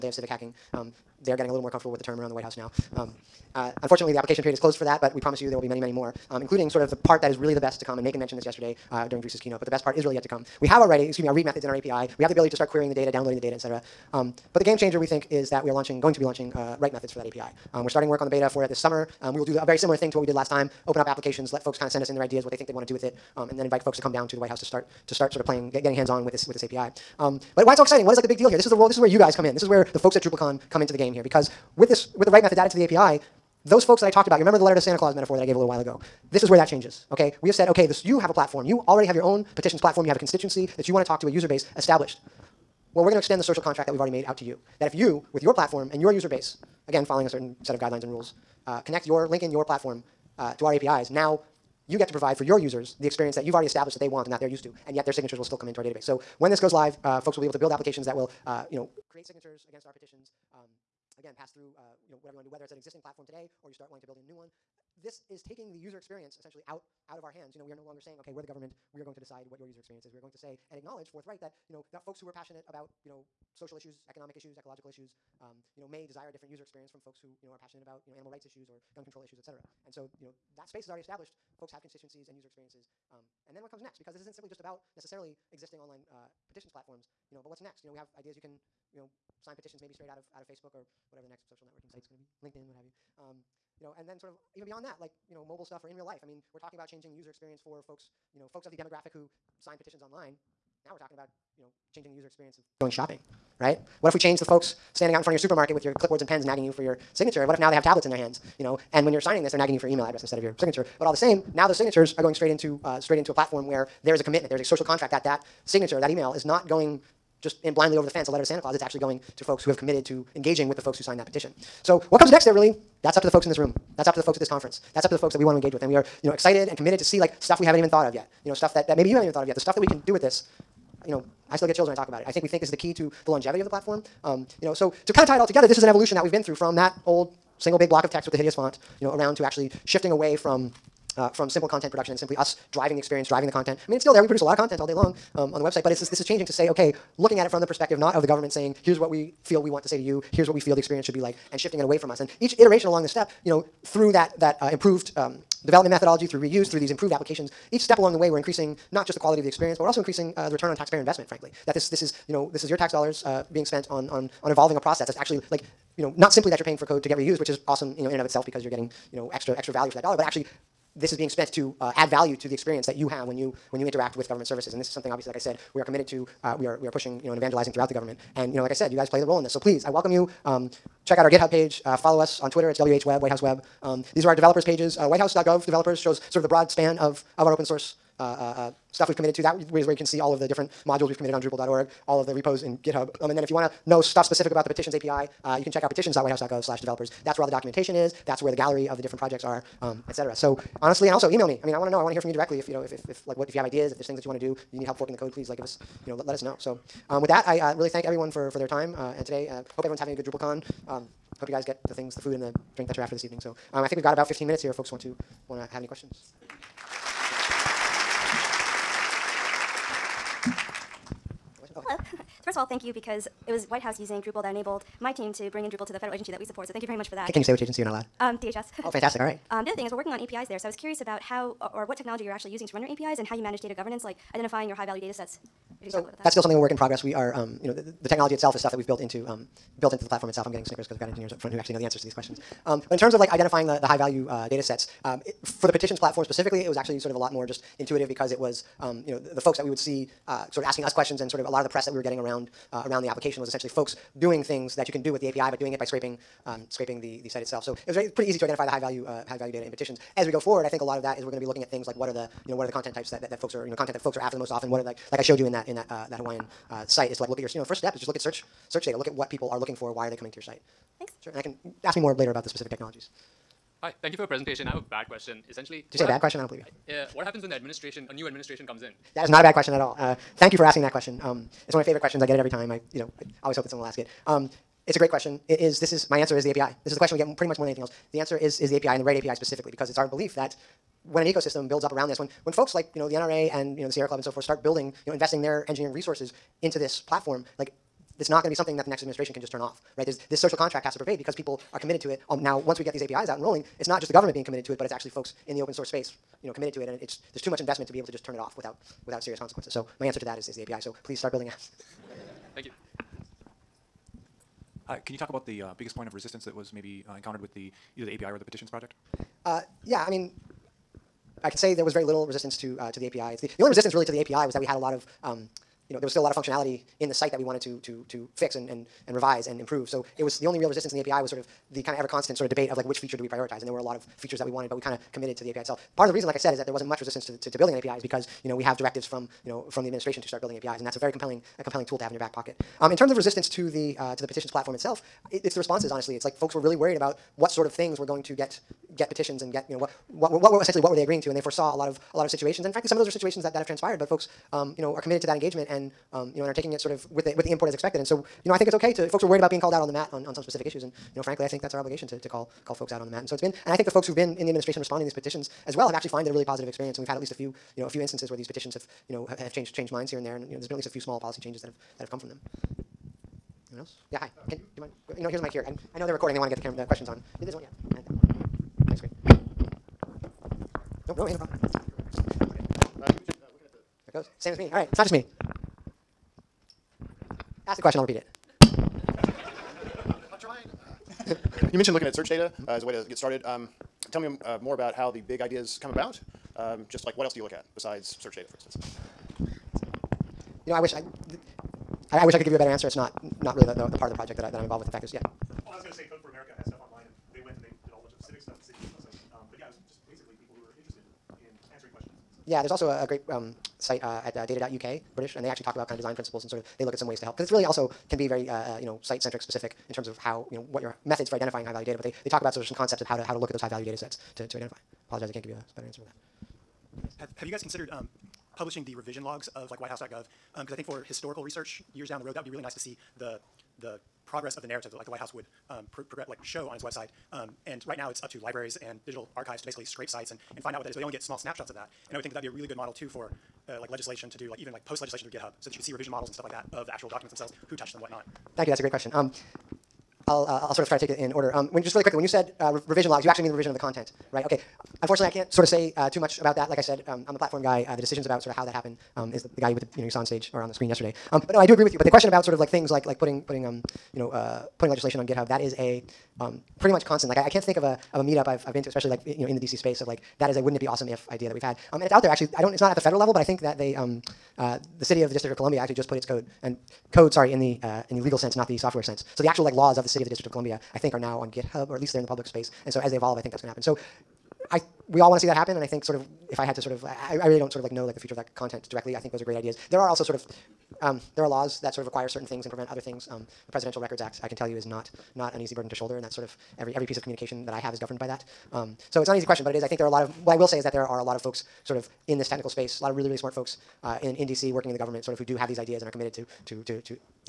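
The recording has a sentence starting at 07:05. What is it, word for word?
Apologize, I can't give you a better answer for that.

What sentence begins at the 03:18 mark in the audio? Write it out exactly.
That's where the gallery of the different projects are, um, et cetera.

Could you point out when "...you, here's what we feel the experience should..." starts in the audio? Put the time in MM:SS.
02:30.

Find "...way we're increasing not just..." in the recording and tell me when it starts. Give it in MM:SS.
02:38.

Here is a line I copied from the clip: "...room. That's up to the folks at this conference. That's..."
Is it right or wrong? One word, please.
right.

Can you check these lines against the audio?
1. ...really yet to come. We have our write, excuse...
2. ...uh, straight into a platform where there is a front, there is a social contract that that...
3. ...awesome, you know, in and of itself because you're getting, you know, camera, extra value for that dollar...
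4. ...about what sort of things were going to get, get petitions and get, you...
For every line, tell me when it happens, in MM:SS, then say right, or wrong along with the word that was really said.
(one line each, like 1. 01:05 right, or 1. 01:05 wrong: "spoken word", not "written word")
1. 00:10 right
2. 01:52 wrong: "commitment", not "front"
3. 02:47 wrong: "extra", not "camera"
4. 05:46 right.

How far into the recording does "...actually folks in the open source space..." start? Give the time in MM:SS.
05:04.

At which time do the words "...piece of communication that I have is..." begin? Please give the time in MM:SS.
08:17.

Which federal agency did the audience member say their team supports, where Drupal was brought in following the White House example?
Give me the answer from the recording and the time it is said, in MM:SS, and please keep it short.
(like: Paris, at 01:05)
DHS, at 03:48.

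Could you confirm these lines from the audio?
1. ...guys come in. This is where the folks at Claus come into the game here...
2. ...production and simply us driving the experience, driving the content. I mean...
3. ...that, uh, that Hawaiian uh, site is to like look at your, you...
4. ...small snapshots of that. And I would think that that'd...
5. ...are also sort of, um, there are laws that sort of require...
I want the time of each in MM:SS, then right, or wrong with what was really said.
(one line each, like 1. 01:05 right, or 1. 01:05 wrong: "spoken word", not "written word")
1. 00:29 wrong: "DrupalCon", not "Claus"
2. 02:21 right
3. 04:25 right
4. 07:21 right
5. 08:10 right.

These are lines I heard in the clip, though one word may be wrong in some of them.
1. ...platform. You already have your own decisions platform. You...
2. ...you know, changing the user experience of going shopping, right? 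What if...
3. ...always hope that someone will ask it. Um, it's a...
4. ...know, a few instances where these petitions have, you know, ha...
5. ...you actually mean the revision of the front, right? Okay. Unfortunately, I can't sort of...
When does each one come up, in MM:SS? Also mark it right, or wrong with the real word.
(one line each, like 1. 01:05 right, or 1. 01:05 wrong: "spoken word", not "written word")
1. 00:38 wrong: "petitions", not "decisions"
2. 01:41 right
3. 04:43 right
4. 06:07 right
5. 07:33 wrong: "content", not "front".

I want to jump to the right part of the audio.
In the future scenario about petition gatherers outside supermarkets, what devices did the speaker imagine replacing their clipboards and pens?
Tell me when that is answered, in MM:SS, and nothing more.
01:47.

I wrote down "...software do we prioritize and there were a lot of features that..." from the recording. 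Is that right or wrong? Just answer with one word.
wrong.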